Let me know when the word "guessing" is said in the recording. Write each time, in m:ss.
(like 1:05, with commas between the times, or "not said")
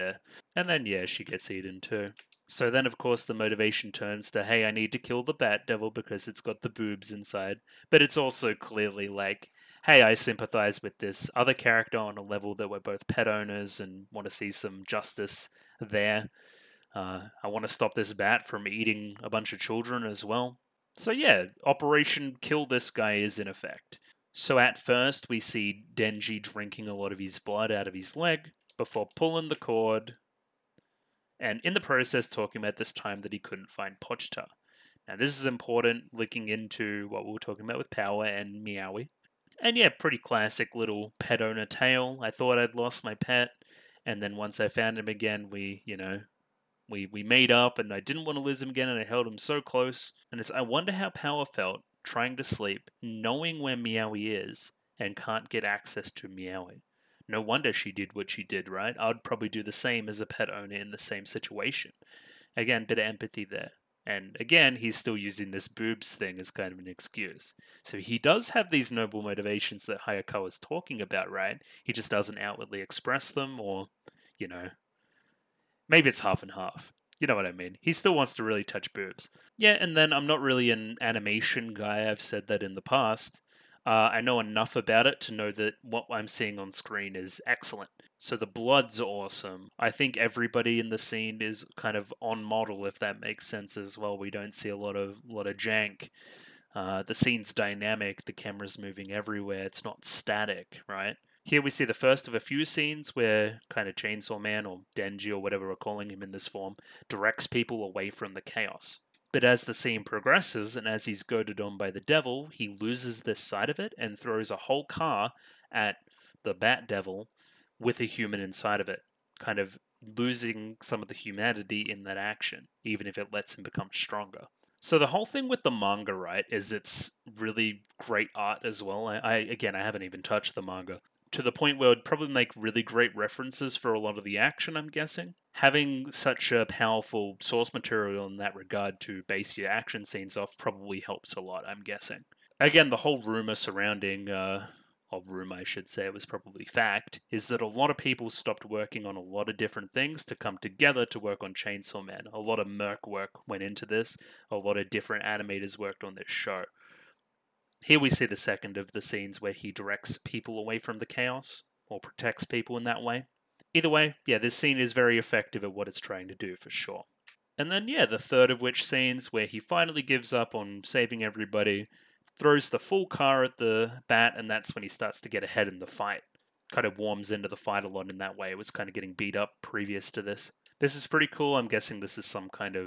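2:14, 2:21, 3:01.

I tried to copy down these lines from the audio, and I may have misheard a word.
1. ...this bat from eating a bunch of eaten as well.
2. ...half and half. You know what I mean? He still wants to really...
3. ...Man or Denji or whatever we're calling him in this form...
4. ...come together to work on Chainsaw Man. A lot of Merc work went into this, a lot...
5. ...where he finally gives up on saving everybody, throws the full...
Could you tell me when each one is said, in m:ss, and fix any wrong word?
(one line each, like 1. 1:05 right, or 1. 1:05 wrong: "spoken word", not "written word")
1. 0:17 wrong: "children", not "eaten"
2. 1:16 right
3. 1:44 right
4. 2:30 right
5. 2:49 right.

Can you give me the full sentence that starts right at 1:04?
And again, he's still using this boobs thing as kind of an excuse.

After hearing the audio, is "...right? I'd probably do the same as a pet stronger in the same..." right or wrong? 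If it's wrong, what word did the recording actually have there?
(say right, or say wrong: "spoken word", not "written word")
wrong: "owner", not "stronger".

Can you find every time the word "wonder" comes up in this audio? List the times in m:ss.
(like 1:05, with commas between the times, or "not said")
0:50, 0:57.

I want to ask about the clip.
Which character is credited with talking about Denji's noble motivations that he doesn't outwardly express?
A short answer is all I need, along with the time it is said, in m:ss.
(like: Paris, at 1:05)
Hayakawa, at 1:10.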